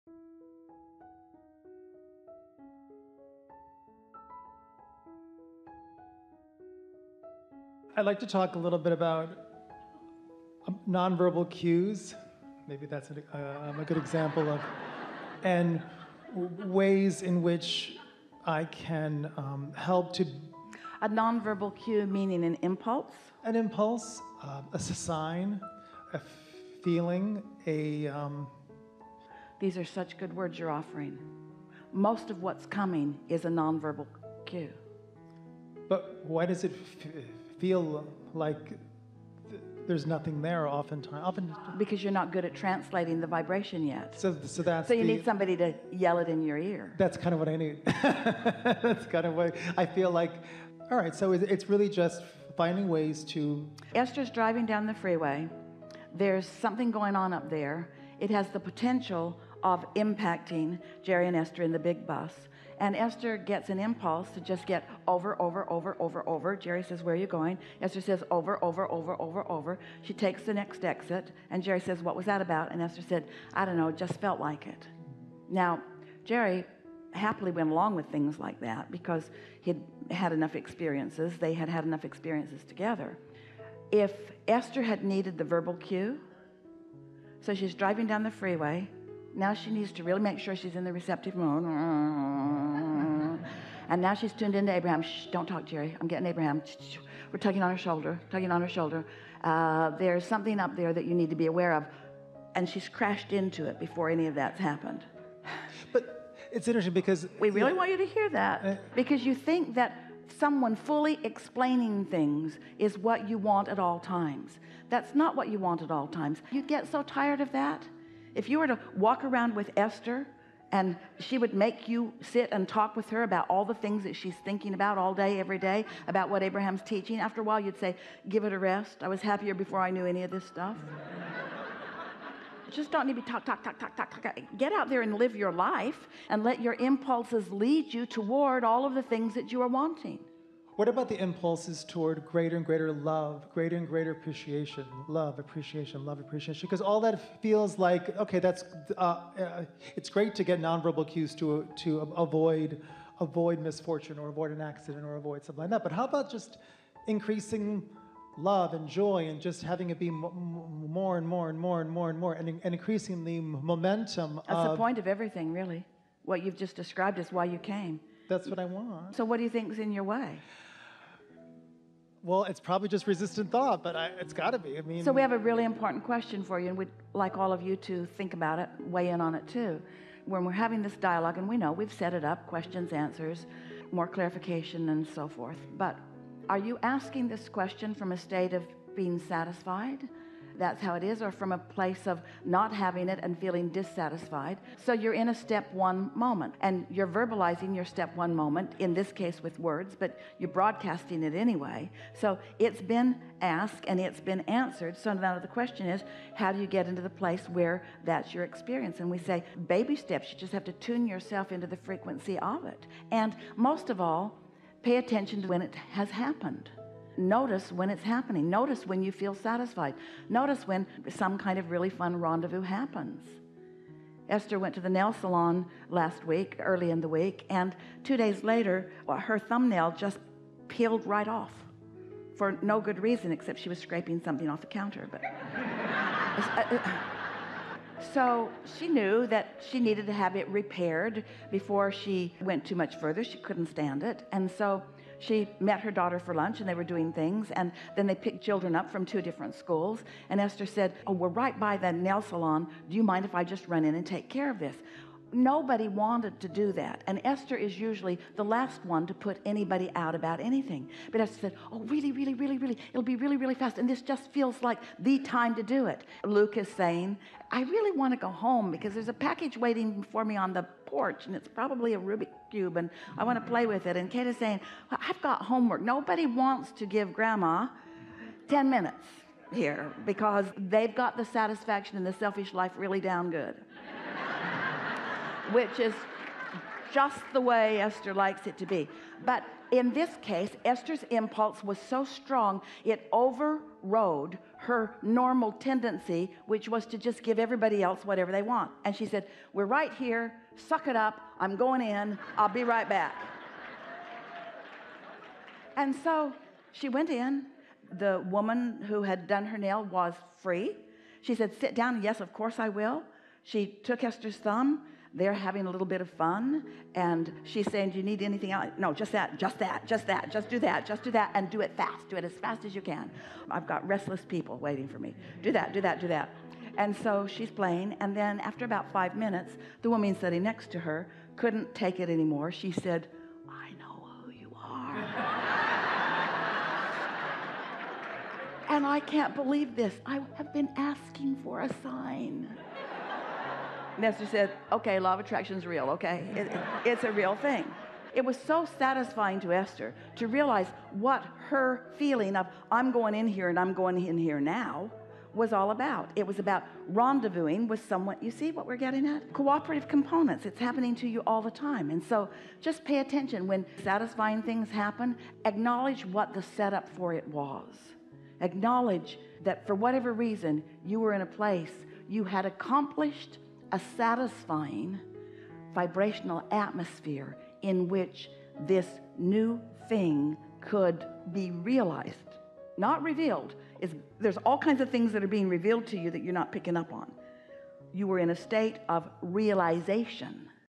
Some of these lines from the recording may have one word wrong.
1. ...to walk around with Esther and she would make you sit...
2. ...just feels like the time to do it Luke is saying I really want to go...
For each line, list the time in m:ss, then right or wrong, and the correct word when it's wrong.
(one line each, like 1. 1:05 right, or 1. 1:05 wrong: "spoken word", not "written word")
1. 1:58 right
2. 4:24 right.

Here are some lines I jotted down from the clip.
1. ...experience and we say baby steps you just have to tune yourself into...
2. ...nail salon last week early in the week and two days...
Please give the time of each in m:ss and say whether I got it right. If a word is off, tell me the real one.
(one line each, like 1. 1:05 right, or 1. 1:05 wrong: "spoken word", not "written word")
1. 3:28 right
2. 3:44 right.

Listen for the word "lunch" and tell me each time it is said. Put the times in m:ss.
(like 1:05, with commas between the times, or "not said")
4:06.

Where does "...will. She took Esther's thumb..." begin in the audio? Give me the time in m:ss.
5:12.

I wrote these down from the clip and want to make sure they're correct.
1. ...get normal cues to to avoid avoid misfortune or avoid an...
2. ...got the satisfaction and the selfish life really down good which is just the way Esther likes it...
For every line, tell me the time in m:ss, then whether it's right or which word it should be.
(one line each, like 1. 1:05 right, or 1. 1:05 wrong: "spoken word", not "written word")
1. 2:30 wrong: "nonverbal", not "normal"
2. 4:40 right.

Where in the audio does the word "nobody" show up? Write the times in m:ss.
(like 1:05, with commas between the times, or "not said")
4:15, 4:35.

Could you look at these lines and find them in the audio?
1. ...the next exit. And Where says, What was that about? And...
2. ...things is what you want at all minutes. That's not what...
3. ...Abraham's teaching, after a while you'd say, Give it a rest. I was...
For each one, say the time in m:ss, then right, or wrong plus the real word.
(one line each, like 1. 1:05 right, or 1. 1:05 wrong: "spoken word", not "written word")
1. 1:10 wrong: "Jerry", not "Where"
2. 1:52 wrong: "times", not "minutes"
3. 2:06 right.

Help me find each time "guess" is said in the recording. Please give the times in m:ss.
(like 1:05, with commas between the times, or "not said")
not said.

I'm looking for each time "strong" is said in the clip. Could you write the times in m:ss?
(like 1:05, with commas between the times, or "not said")
4:52.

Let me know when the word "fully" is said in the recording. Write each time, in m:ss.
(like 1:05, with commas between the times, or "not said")
1:50.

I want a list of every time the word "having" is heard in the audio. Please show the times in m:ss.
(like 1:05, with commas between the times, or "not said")
2:39, 3:00, 3:12, 5:15.